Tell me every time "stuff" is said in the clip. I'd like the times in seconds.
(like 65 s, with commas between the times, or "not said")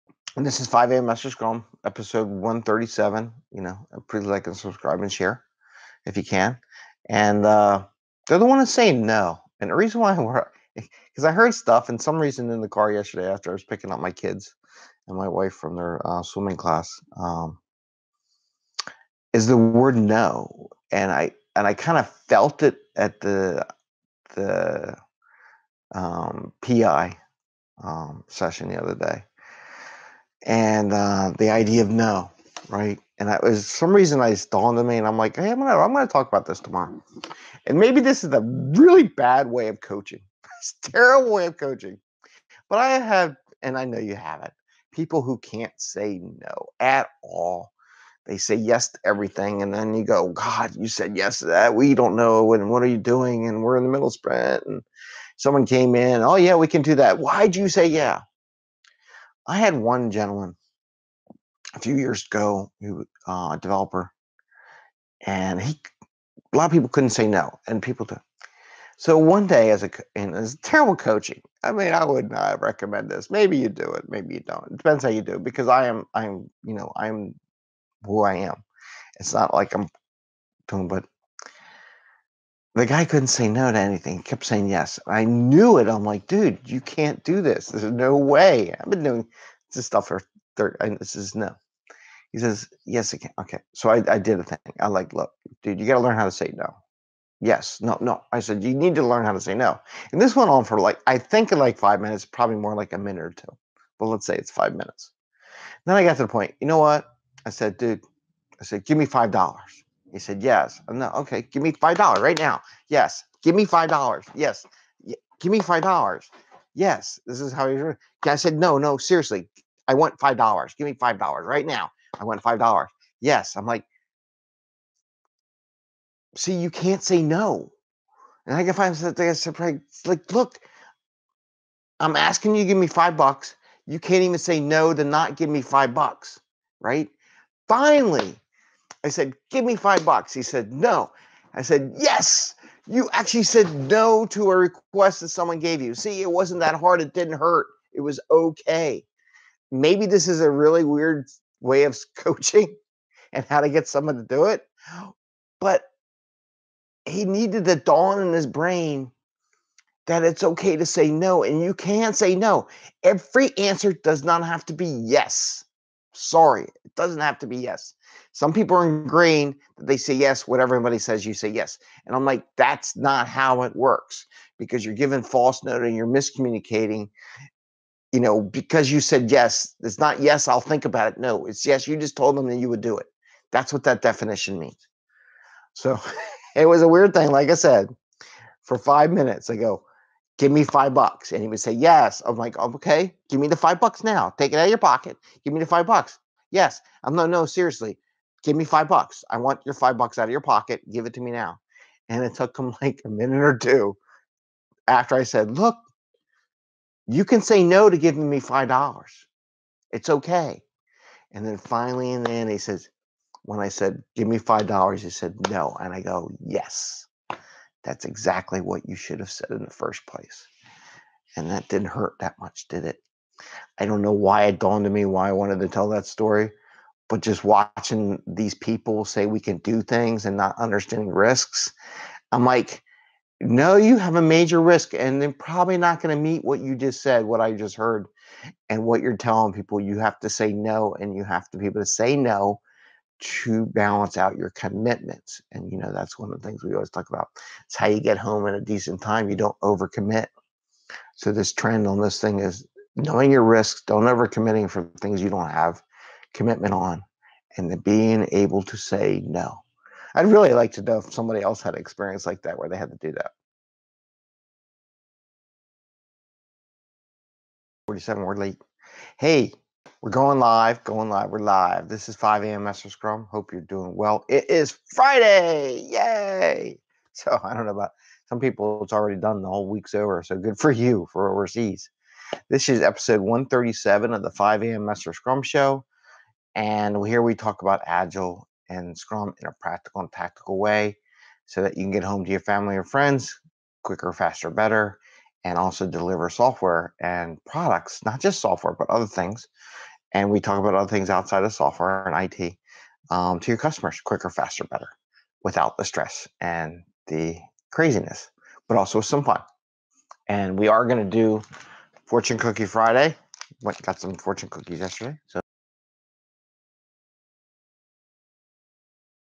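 11 s, 89 s.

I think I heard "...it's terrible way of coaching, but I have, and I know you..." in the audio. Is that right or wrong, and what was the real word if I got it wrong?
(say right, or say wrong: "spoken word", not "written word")
right.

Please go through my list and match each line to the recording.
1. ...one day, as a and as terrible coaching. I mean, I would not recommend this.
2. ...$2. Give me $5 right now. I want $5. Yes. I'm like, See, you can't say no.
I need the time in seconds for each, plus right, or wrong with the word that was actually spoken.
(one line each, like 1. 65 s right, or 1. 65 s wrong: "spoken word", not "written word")
1. 69 s right
2. 120 s wrong: "5", not "2".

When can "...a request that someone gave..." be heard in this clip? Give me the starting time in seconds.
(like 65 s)
144 s.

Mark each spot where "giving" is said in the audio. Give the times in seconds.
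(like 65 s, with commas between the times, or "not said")
174 s, 207 s.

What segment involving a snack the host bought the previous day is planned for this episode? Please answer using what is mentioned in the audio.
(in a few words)
Fortune Cookie Friday.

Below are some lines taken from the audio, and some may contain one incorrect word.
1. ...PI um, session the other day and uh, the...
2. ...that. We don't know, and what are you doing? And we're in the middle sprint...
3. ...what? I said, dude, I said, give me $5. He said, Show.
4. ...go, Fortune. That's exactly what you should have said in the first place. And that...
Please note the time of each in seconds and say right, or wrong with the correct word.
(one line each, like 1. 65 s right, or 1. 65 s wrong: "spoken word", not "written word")
1. 26 s right
2. 51 s right
3. 106 s wrong: "Yes", not "Show"
4. 216 s wrong: "Yes", not "Fortune".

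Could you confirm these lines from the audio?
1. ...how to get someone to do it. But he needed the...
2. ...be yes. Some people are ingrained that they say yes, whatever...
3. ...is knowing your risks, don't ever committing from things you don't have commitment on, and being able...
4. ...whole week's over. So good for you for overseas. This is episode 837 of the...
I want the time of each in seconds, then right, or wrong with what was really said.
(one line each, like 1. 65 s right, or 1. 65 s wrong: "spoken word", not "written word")
1. 153 s right
2. 167 s right
3. 252 s right
4. 279 s wrong: "137", not "837".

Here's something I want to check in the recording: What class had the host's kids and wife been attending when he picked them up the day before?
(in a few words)
swimming class.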